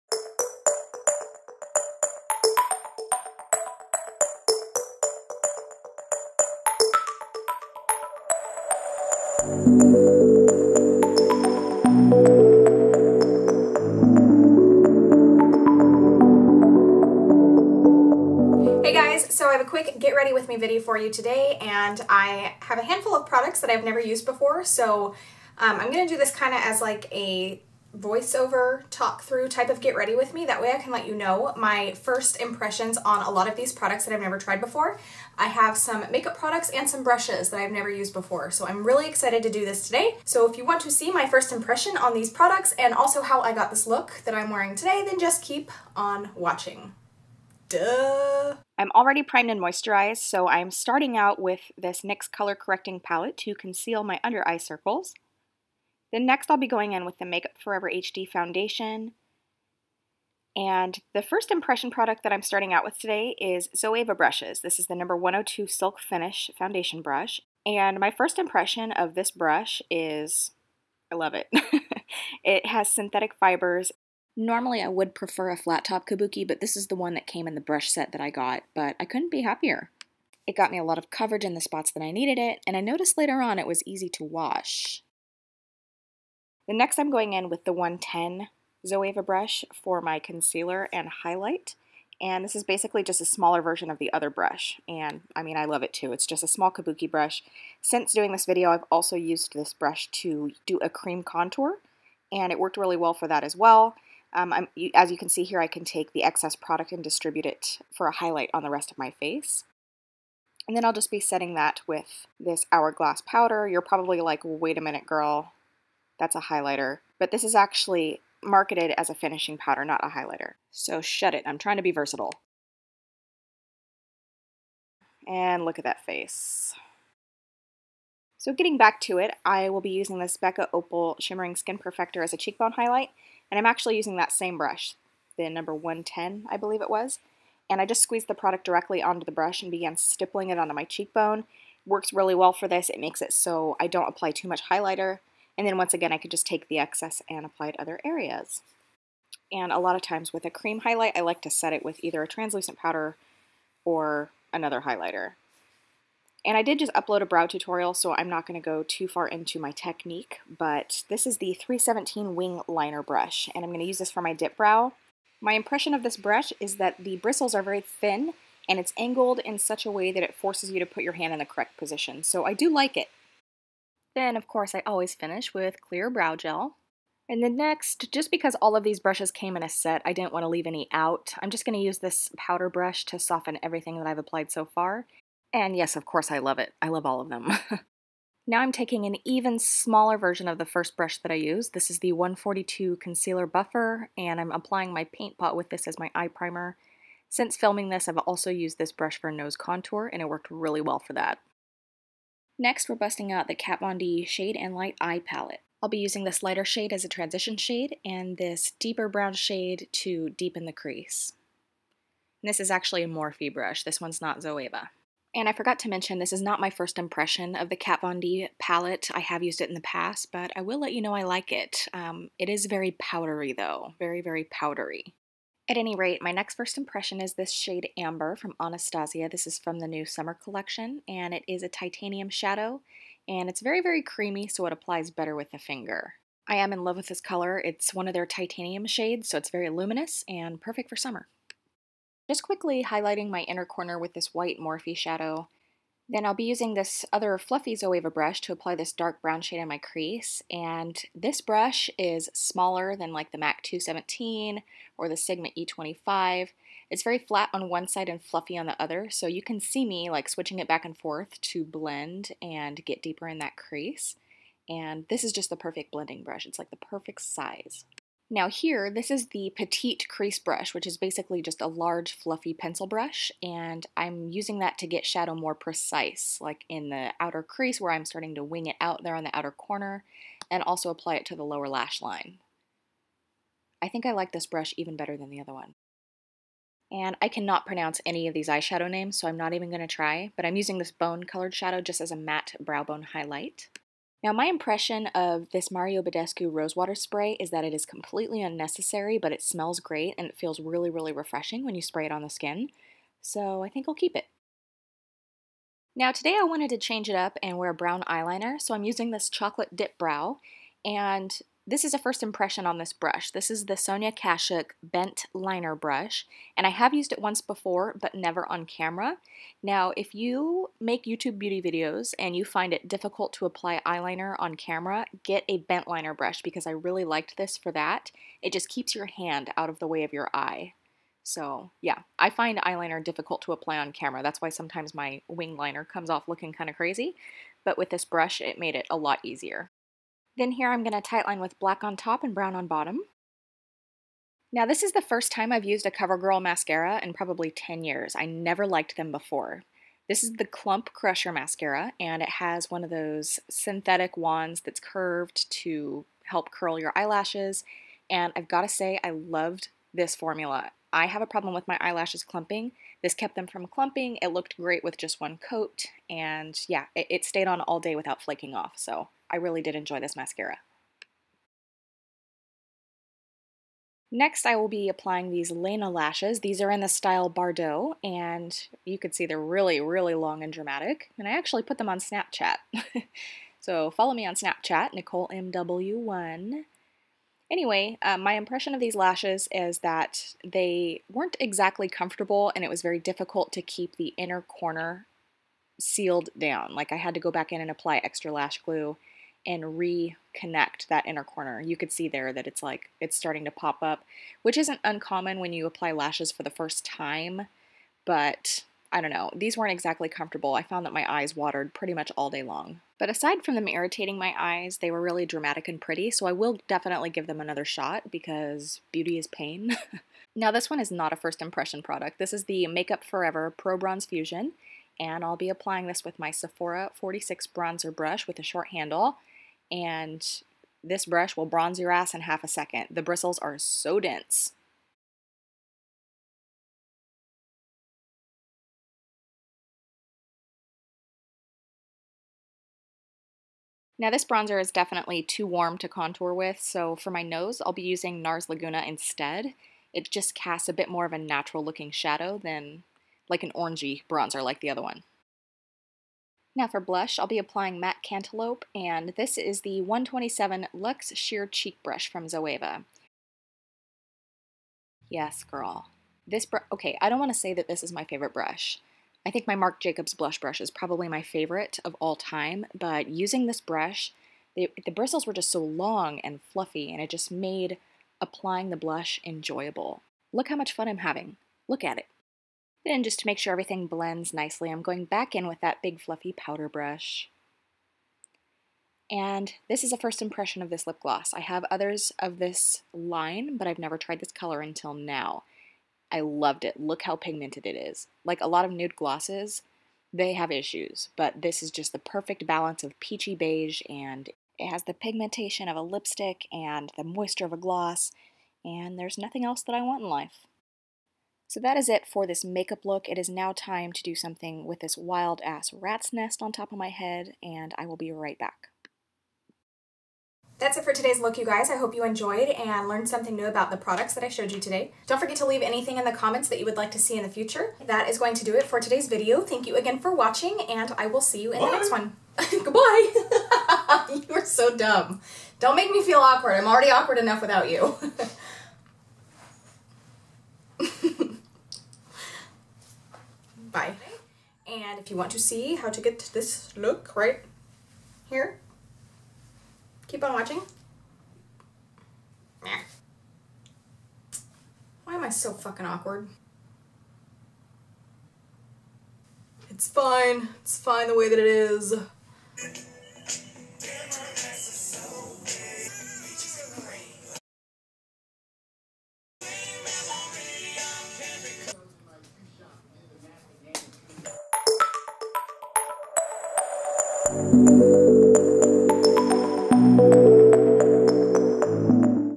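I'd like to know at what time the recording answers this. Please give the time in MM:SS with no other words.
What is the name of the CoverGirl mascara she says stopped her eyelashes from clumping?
05:50.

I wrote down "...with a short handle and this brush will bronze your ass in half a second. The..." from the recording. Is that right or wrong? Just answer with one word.
right.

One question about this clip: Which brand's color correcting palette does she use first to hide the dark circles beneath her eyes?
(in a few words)
NYX.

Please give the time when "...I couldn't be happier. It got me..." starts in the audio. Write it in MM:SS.
01:18.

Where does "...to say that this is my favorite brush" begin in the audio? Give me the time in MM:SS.
07:47.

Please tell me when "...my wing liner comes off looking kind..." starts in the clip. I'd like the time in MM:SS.
05:34.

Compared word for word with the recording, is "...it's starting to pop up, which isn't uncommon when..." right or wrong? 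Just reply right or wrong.
right.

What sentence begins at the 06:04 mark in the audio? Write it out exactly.
It looked great with just one coat and yeah, it, it stayed on all day without flaking off.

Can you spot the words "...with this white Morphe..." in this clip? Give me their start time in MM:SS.
04:03.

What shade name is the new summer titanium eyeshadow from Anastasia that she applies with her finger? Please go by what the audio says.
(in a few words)
Amber.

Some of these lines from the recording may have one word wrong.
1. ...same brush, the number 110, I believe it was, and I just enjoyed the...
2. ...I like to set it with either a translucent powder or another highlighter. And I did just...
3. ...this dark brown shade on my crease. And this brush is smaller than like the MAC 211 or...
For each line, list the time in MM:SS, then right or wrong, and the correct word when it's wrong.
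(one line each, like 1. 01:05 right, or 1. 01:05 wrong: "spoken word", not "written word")
1. 02:14 wrong: "squeezed", not "enjoyed"
2. 02:31 right
3. 04:08 wrong: "217", not "211".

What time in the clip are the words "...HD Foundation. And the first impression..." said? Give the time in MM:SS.
00:57.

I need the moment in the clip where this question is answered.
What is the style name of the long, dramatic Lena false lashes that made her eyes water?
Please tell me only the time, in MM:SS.
06:17.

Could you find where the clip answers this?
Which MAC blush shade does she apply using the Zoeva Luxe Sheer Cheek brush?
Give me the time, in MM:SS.
07:38.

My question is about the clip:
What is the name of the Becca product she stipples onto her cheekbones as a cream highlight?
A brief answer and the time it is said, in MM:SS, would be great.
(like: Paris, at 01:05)
Opal, at 02:10.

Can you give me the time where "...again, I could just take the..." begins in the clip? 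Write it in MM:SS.
02:25.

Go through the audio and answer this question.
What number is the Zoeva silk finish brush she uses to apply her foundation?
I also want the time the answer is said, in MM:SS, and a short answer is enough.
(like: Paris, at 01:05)
102, at 01:05.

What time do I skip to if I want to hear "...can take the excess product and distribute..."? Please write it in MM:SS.
01:45.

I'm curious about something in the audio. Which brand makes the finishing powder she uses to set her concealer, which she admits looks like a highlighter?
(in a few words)
Hourglass.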